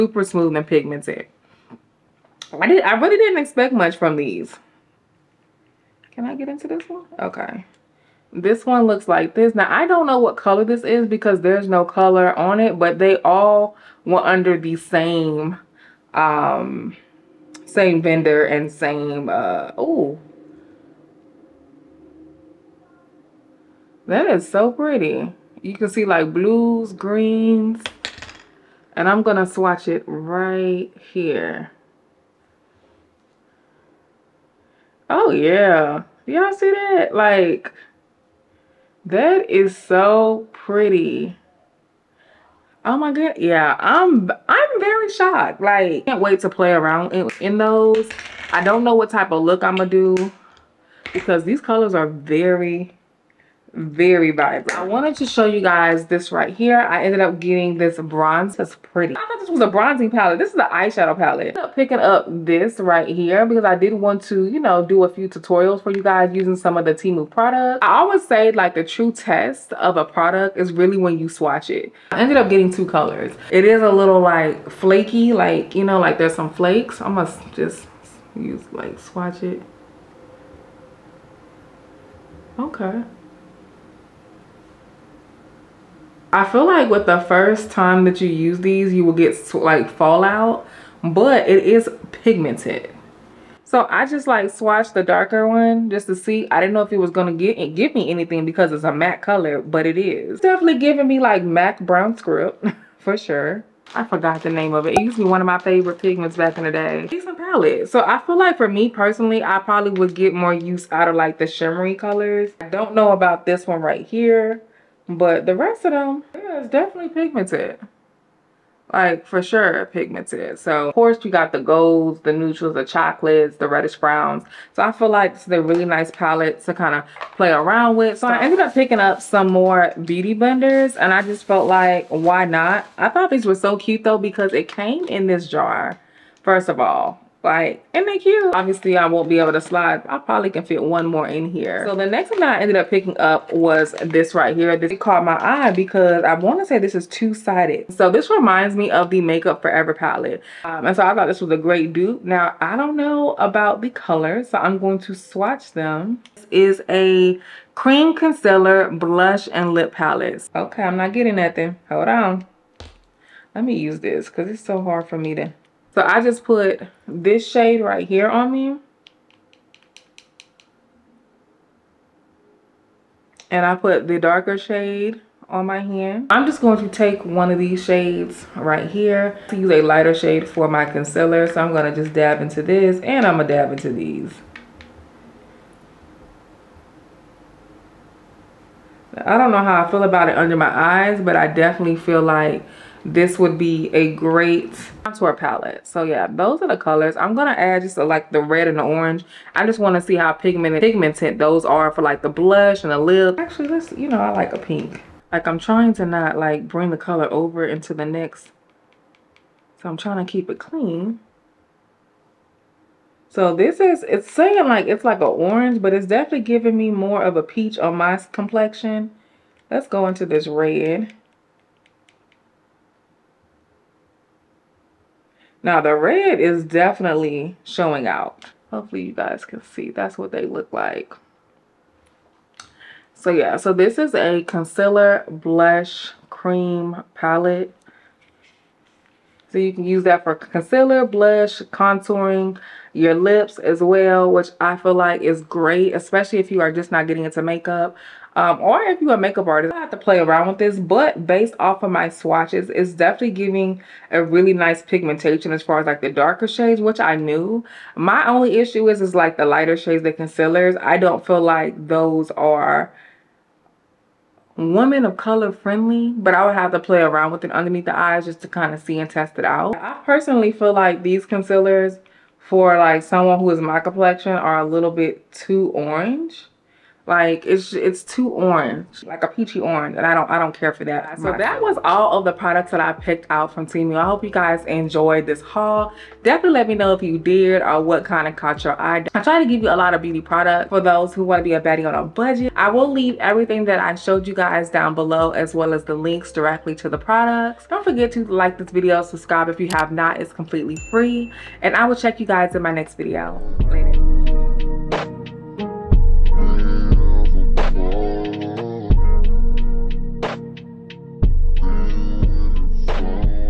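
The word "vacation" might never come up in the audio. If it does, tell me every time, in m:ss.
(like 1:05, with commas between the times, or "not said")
not said.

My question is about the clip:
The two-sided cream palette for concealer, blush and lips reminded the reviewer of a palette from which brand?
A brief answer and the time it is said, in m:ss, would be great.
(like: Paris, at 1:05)
Makeup Forever, at 2:29.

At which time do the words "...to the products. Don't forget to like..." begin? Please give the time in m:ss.
4:56.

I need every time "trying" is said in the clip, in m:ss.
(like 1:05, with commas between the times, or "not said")
3:25, 3:29.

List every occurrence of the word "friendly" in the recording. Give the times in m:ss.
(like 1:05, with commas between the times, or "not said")
4:25.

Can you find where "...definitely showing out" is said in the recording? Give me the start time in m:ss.
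3:46.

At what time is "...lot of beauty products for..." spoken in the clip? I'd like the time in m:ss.
4:49.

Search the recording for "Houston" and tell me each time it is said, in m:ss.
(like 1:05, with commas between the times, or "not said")
not said.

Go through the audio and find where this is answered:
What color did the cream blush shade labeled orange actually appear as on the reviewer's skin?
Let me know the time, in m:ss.
3:37.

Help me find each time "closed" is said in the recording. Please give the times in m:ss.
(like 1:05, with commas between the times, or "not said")
not said.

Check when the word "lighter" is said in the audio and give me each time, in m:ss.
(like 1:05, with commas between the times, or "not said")
2:59, 4:19.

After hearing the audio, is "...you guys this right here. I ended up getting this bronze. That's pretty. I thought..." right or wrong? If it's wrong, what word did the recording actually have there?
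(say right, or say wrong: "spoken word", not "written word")
right.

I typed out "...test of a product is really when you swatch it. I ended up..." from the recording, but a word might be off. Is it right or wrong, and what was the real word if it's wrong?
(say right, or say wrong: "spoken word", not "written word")
right.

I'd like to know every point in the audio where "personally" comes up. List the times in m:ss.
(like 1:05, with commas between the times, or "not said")
1:48, 4:30.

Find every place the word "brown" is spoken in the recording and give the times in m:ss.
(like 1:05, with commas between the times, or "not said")
1:41, 2:03.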